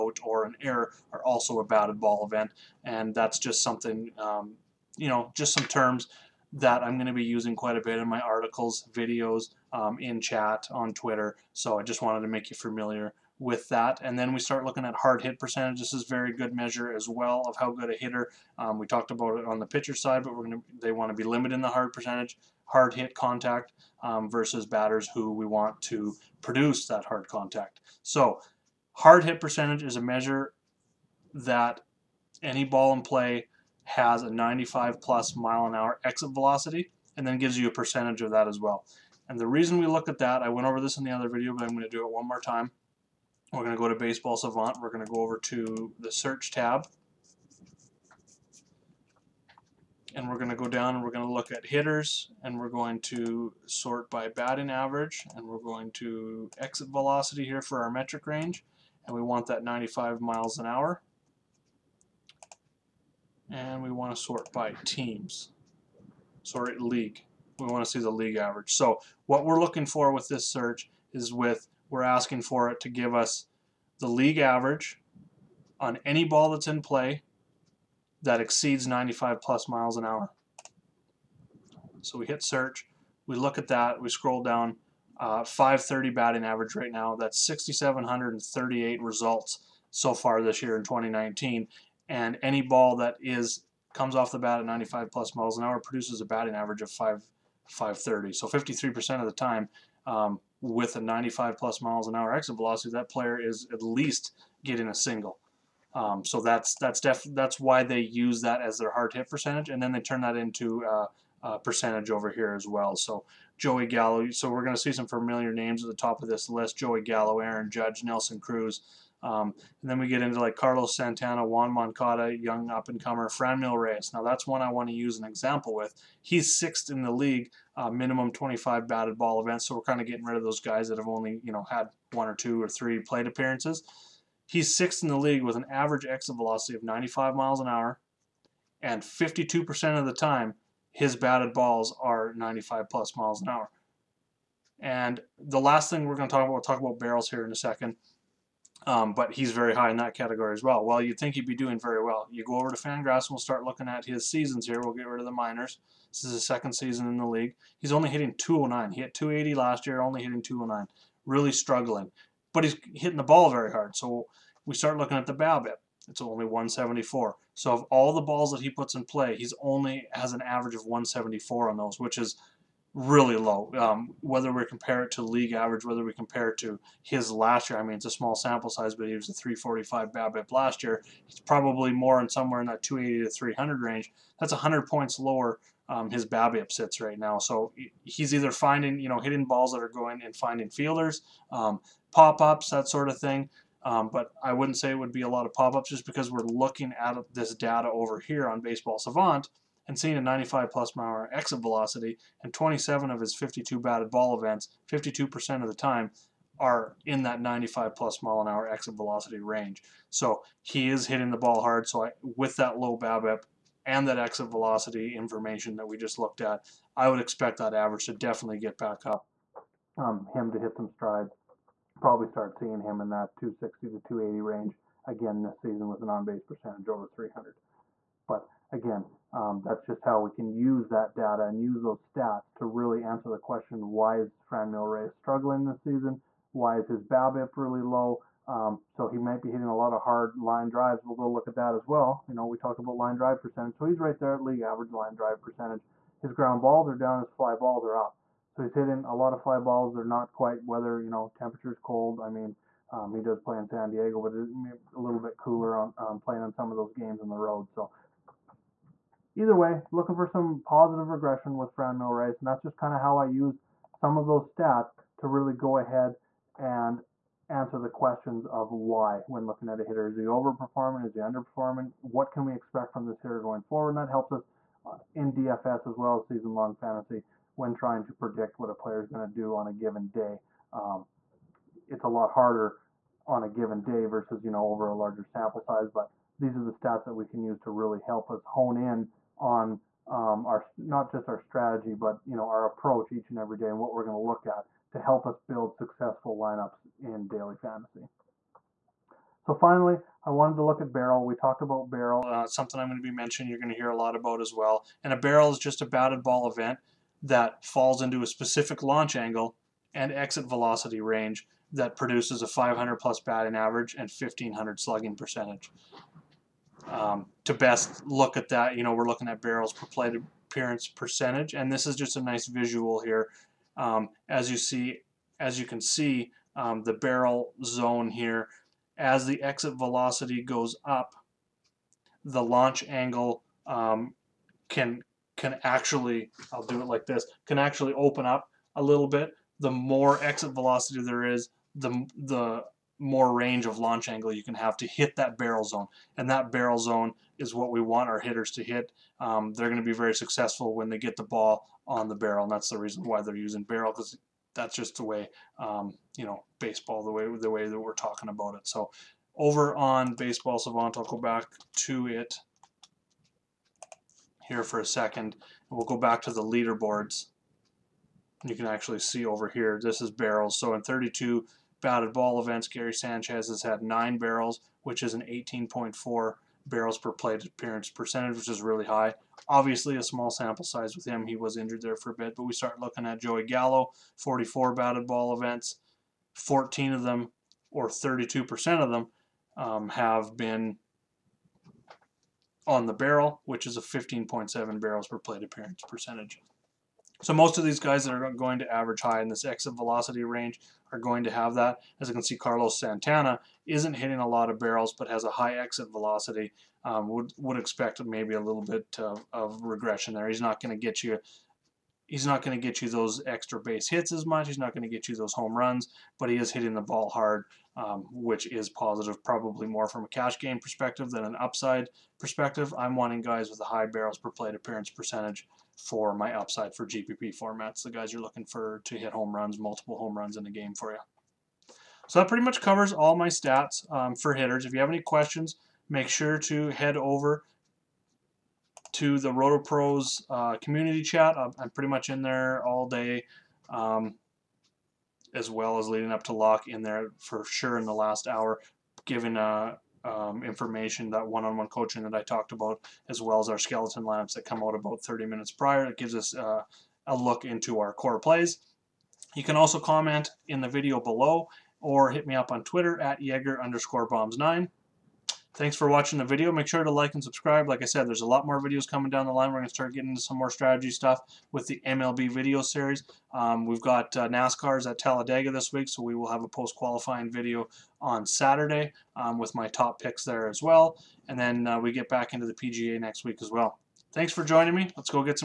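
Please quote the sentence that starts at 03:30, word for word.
So he is hitting the ball hard.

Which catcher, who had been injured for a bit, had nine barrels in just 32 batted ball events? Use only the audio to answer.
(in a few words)
Gary Sanchez.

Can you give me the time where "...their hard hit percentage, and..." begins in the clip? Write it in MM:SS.
01:48.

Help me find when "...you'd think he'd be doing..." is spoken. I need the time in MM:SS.
02:30.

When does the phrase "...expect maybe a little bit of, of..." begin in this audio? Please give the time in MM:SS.
06:47.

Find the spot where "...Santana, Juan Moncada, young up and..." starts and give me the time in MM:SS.
02:00.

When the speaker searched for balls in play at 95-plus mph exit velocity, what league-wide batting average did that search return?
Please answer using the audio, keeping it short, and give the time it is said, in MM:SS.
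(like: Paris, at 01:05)
.530, at 01:25.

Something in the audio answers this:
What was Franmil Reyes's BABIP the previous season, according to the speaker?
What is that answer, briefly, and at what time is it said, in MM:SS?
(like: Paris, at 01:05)
.345, at 02:59.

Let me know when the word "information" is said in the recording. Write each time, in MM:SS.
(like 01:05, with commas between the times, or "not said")
03:35, 07:30.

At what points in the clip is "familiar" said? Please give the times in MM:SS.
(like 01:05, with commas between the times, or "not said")
00:12, 01:55.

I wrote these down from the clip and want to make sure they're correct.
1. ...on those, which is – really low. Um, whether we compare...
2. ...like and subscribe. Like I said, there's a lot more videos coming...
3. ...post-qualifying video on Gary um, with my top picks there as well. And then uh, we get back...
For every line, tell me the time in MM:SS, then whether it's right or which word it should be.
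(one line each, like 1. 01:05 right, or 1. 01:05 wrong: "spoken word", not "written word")
1. 02:51 right
2. 07:46 right
3. 07:56 wrong: "Saturday", not "Gary".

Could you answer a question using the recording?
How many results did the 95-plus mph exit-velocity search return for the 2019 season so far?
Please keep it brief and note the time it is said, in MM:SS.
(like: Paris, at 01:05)
6,738, at 01:27.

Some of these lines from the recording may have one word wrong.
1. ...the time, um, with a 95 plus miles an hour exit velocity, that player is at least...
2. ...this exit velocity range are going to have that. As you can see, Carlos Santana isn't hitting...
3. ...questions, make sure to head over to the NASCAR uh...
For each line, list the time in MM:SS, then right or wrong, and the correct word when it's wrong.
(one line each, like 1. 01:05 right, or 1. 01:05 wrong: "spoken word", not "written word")
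1. 01:39 right
2. 06:39 right
3. 07:15 wrong: "RotoPros", not "NASCAR".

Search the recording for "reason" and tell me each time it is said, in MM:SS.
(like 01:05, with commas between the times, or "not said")
00:39, 05:52.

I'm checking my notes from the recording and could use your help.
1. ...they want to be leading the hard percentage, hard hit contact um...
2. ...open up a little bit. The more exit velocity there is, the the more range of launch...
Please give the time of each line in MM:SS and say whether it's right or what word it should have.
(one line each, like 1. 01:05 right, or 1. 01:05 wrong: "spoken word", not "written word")
1. 00:20 wrong: "limiting", not "leading"
2. 05:37 right.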